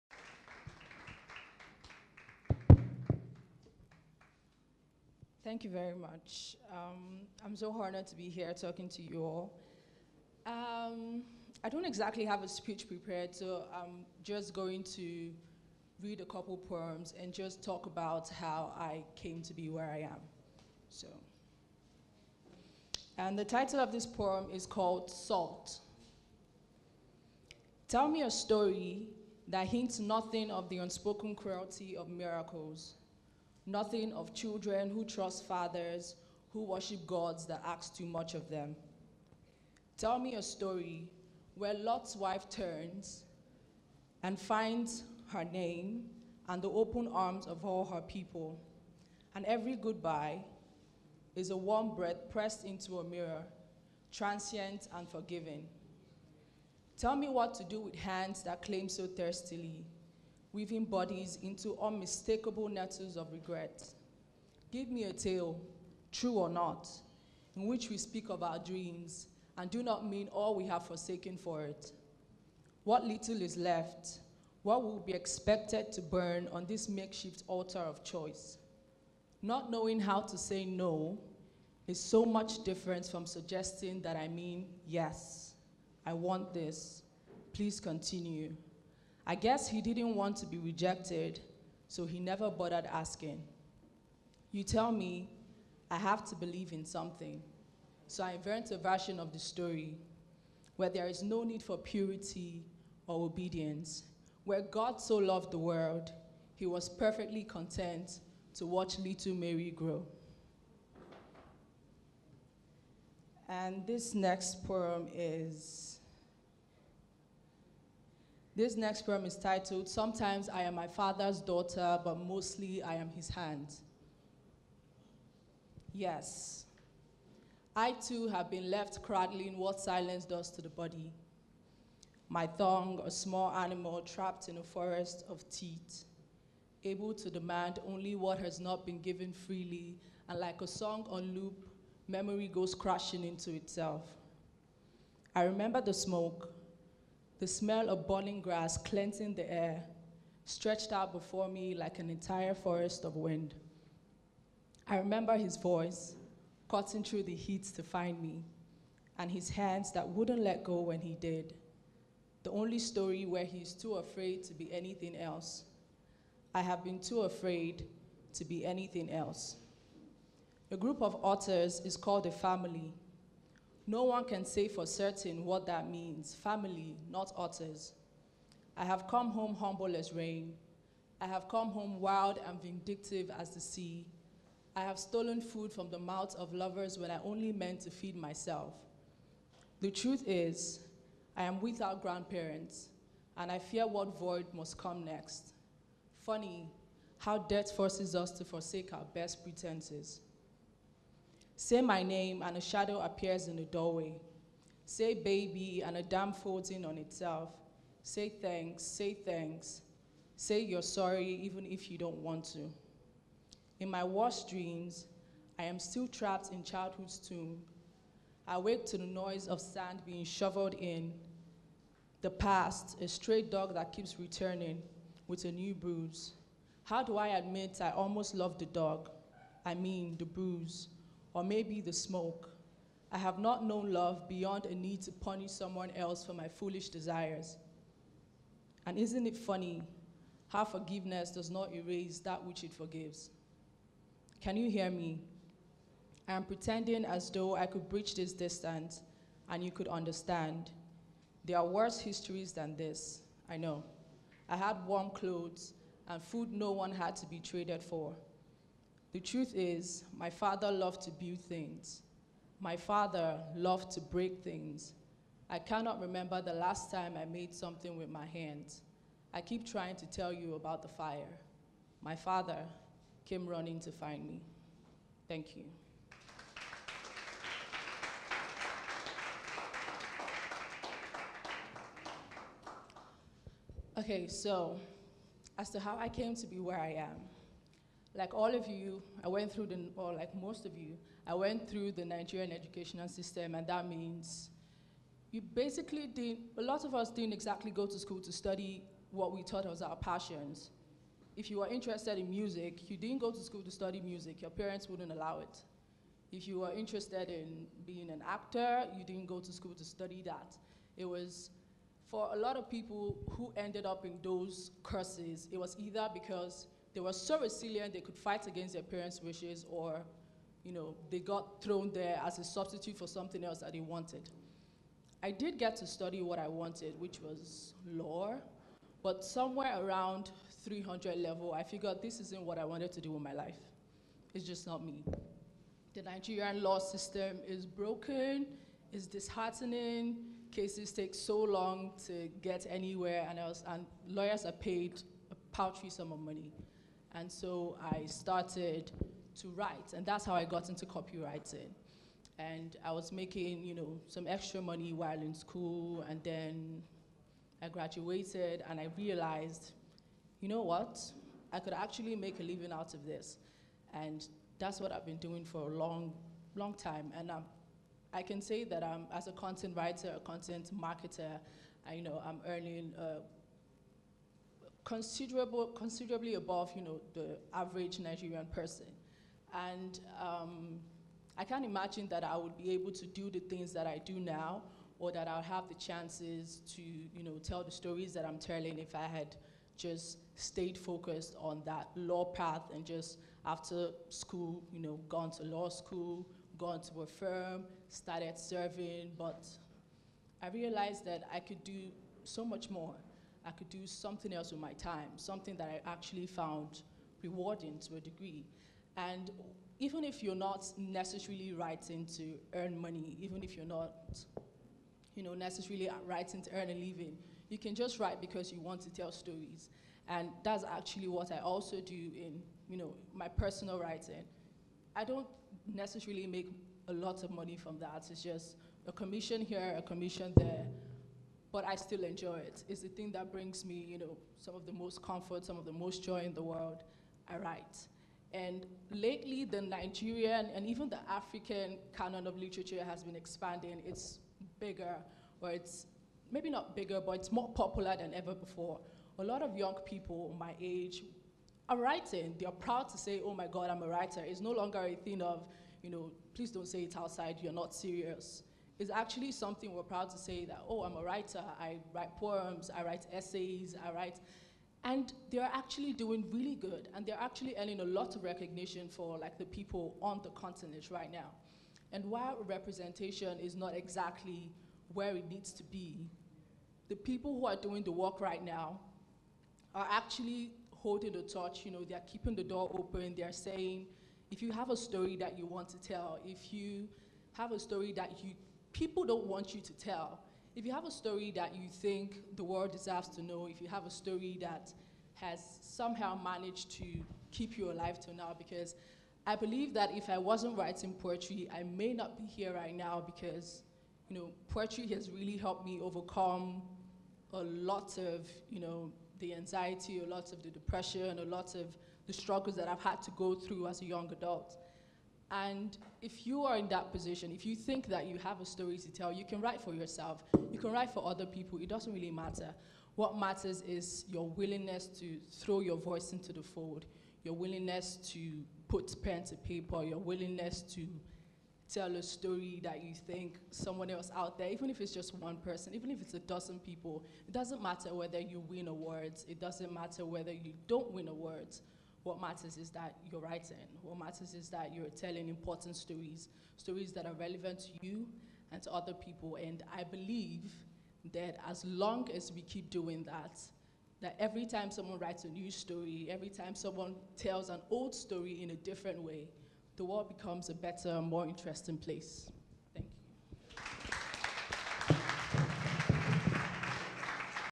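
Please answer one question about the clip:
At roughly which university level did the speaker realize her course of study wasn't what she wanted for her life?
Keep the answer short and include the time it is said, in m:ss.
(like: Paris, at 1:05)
300 level, at 5:30.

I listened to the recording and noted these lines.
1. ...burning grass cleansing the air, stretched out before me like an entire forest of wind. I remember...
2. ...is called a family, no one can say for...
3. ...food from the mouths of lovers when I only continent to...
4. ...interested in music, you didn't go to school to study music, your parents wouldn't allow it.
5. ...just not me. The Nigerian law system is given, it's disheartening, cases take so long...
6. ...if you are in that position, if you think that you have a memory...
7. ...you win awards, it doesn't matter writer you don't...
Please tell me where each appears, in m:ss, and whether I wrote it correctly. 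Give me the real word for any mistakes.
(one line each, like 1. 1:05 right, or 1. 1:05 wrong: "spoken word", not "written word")
1. 2:28 right
2. 2:51 right
3. 3:05 wrong: "meant", not "continent"
4. 5:01 right
5. 5:34 wrong: "broken", not "given"
6. 8:36 wrong: "story", not "memory"
7. 8:58 wrong: "whether", not "writer".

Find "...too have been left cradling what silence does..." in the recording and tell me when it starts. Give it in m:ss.
2:07.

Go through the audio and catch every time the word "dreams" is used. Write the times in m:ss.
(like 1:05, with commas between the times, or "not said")
1:08, 3:34.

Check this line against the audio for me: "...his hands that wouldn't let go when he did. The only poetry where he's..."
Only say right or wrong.
wrong.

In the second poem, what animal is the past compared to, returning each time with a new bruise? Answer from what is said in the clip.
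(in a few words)
A stray dog.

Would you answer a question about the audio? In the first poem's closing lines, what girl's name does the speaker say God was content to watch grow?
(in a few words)
Mary.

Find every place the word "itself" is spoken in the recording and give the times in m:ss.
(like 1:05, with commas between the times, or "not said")
2:23, 3:26.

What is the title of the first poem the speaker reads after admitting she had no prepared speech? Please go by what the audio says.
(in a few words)
Salt.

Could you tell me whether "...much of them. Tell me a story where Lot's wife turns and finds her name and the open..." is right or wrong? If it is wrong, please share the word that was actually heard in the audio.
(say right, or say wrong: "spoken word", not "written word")
right.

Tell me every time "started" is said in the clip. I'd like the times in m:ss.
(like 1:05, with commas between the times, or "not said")
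5:48, 6:37.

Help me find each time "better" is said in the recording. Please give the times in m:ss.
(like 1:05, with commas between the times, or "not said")
9:20.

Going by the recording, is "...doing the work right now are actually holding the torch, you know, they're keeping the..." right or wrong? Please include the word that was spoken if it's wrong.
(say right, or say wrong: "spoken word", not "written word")
right.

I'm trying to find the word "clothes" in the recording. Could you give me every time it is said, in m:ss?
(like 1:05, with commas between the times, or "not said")
4:15.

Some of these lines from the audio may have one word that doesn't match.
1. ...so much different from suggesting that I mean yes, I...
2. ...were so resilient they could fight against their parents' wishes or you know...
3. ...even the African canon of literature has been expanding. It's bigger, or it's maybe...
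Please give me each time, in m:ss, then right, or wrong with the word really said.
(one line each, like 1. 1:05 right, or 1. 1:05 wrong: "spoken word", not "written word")
1. 1:21 right
2. 5:16 right
3. 7:20 right.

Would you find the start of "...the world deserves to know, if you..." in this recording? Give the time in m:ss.
8:12.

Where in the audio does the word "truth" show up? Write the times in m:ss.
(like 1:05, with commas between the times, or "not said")
3:09, 4:19.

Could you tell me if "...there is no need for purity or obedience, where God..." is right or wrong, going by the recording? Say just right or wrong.
right.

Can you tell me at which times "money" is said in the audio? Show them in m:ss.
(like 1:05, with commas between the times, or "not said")
5:46, 5:54, 6:52, 7:07.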